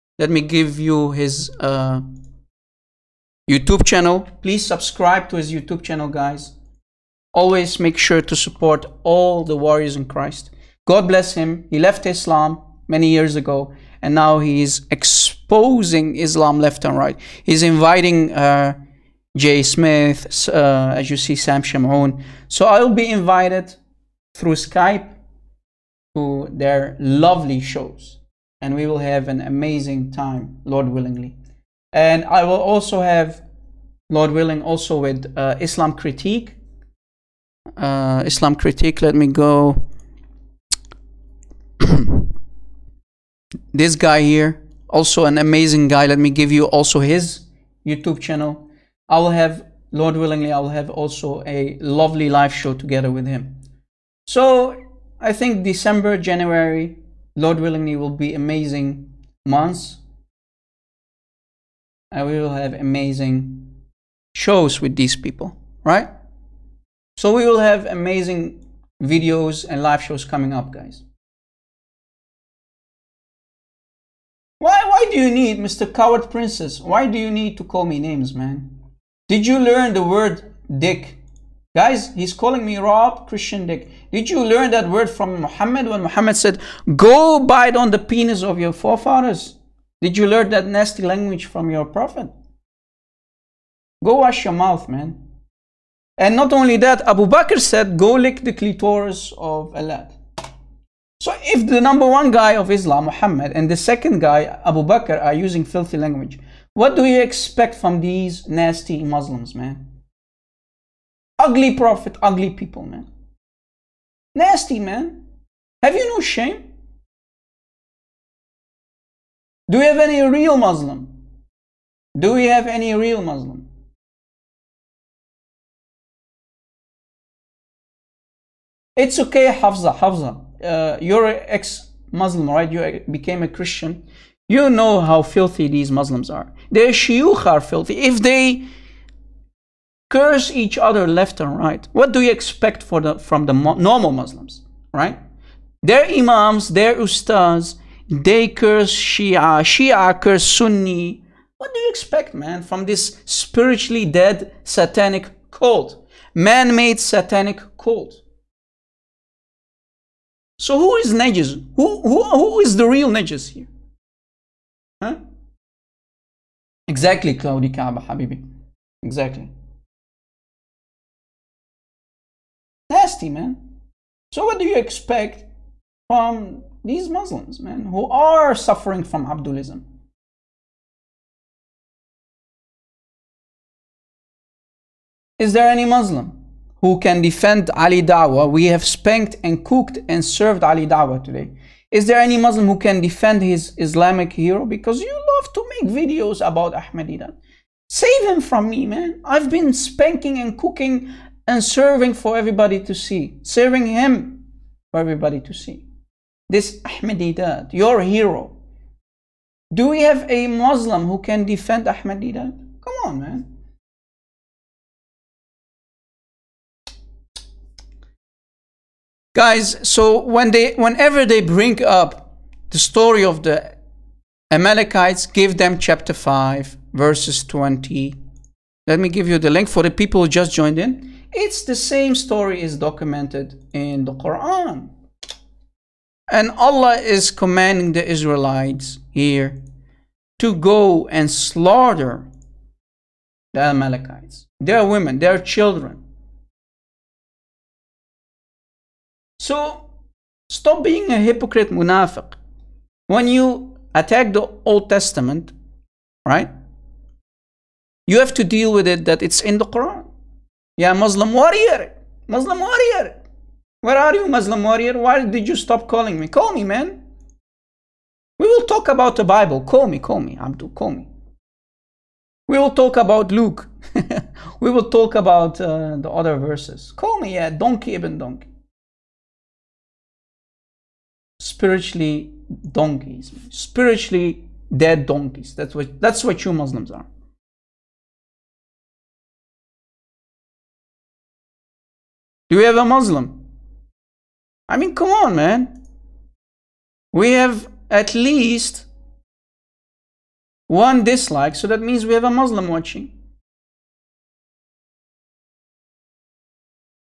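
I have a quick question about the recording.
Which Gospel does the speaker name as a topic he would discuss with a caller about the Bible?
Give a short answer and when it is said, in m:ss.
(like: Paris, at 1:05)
Luke, at 4:33.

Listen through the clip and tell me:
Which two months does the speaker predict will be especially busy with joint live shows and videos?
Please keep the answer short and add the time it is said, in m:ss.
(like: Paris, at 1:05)
December, January, at 0:55.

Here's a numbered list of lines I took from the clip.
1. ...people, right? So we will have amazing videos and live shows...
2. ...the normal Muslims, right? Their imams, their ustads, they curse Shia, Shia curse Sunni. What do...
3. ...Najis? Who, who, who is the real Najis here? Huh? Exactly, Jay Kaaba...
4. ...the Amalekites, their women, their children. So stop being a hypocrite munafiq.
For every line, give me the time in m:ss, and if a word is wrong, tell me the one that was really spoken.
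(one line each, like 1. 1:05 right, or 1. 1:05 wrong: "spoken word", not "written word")
1. 1:05 right
2. 2:23 right
3. 2:41 wrong: "Claudia", not "Jay"
4. 4:03 right.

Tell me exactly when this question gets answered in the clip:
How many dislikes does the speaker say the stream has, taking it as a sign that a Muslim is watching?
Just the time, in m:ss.
5:00.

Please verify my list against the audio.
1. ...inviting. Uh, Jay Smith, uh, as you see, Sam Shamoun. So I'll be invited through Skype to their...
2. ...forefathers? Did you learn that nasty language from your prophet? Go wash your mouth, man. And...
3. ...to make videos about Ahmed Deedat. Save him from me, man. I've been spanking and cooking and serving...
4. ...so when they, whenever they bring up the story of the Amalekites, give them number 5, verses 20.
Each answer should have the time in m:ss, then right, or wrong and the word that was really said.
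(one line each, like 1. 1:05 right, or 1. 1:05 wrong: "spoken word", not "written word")
1. 0:17 right
2. 1:28 right
3. 3:15 right
4. 3:39 wrong: "chapter", not "number".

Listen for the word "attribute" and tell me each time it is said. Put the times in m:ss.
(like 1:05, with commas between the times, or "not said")
not said.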